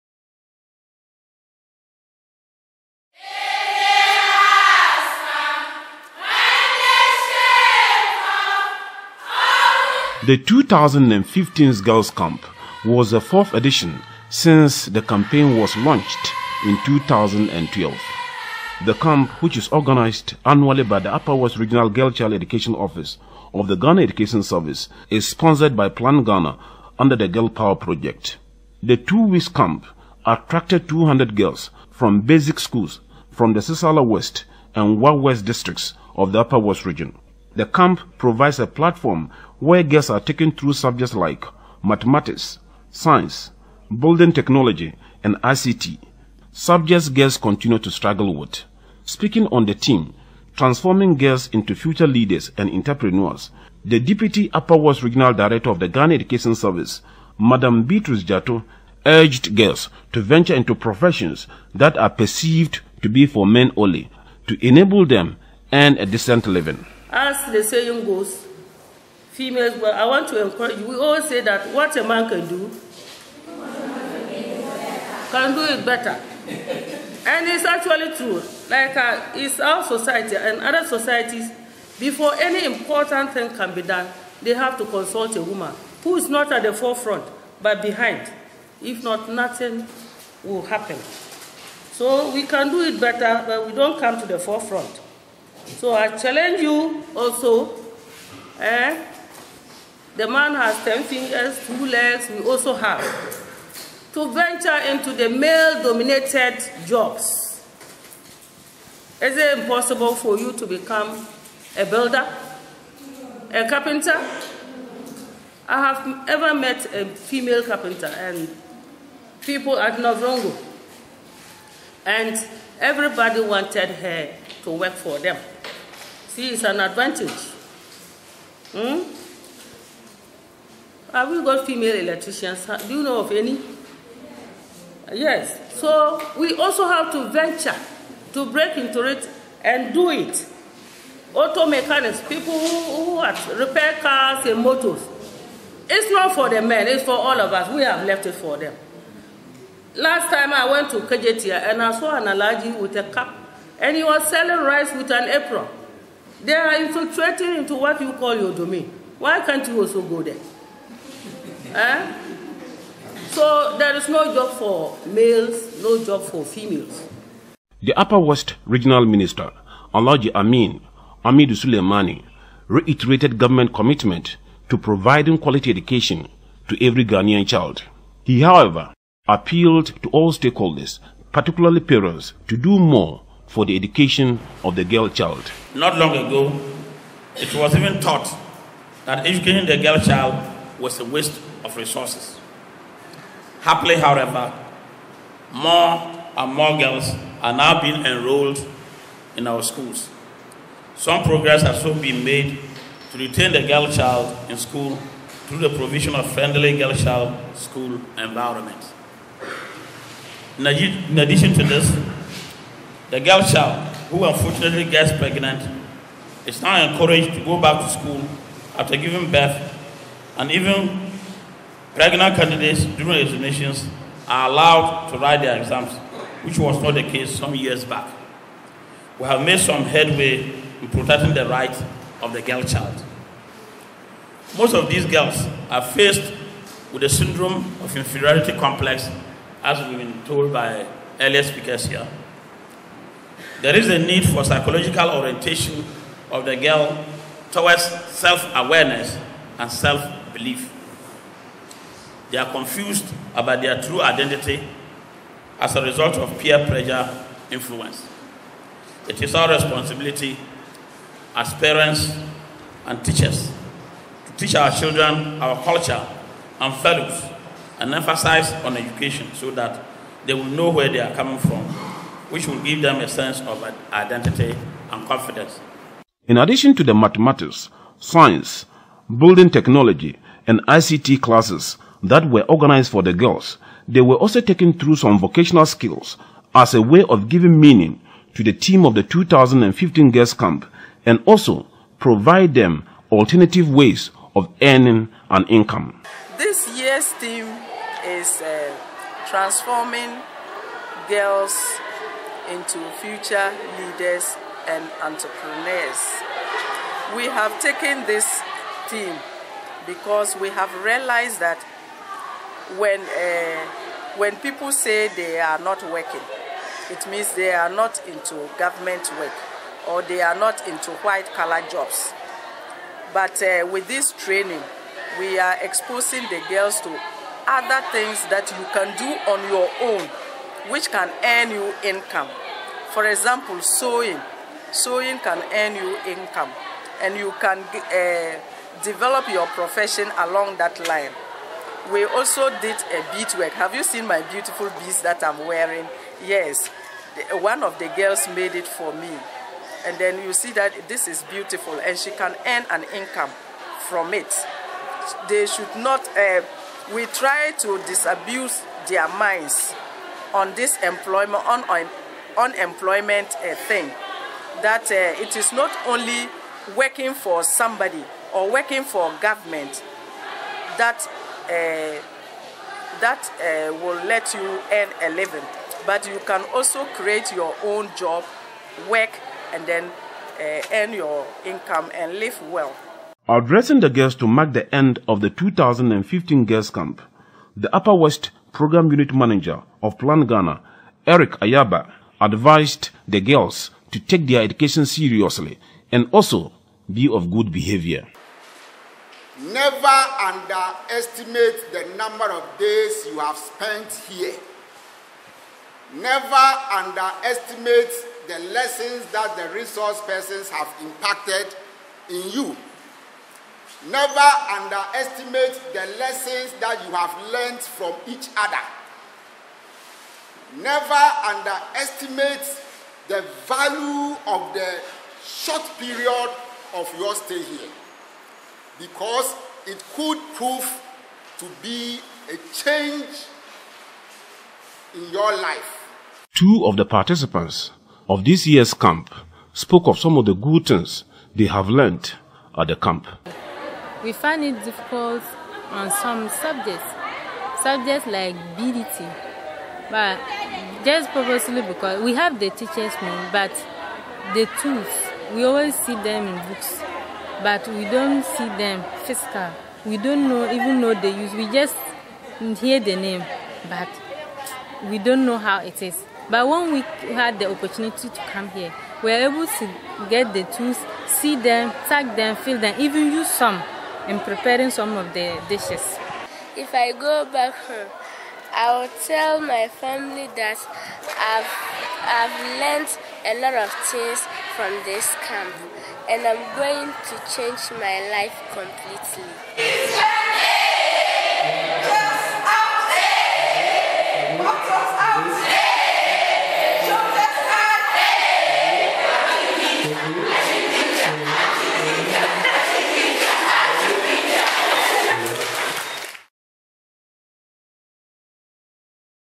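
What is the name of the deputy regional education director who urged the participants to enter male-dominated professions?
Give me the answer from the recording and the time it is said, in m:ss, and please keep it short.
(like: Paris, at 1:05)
Beatrice Jato, at 0:57.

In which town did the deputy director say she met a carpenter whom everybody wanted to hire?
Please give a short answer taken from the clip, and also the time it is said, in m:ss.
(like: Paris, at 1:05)
Navrongo, at 1:59.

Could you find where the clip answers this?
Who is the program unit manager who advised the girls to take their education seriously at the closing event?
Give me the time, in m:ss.
6:31.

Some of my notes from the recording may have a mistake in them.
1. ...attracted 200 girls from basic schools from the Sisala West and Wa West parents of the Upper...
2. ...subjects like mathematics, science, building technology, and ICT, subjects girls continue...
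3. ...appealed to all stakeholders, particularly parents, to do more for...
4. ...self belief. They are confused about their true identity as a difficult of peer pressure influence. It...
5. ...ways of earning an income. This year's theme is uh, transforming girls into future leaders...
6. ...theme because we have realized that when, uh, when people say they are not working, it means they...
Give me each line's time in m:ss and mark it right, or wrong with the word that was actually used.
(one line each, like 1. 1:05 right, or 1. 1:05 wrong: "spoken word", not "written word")
1. 0:30 wrong: "districts", not "parents"
2. 0:40 right
3. 2:59 right
4. 4:09 wrong: "result", not "difficult"
5. 4:53 right
6. 5:08 right.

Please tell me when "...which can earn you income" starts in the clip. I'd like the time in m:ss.
5:30.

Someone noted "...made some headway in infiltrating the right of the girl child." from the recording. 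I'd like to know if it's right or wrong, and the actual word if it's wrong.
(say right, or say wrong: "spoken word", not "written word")
wrong: "protecting", not "infiltrating".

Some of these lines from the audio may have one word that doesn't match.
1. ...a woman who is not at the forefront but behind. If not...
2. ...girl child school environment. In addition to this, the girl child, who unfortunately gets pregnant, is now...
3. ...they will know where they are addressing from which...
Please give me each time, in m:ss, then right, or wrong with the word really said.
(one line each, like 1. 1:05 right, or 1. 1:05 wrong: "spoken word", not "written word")
1. 1:25 right
2. 3:26 right
3. 4:30 wrong: "coming", not "addressing".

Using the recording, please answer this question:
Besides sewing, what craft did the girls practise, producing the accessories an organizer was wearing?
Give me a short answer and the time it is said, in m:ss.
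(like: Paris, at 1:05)
Bead work, at 5:43.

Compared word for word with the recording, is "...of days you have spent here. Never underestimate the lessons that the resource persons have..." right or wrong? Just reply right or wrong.
right.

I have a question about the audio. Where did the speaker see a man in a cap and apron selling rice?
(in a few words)
Kejetia.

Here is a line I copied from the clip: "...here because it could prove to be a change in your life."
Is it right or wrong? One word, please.
right.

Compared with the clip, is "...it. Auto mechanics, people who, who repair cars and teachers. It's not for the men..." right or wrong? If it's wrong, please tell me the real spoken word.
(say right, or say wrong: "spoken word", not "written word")
wrong: "motors", not "teachers".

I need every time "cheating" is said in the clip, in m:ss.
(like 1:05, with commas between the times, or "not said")
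not said.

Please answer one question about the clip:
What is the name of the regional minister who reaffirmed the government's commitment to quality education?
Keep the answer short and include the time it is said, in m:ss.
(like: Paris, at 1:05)
Alhaji Amin Amidu Sulemana, at 2:49.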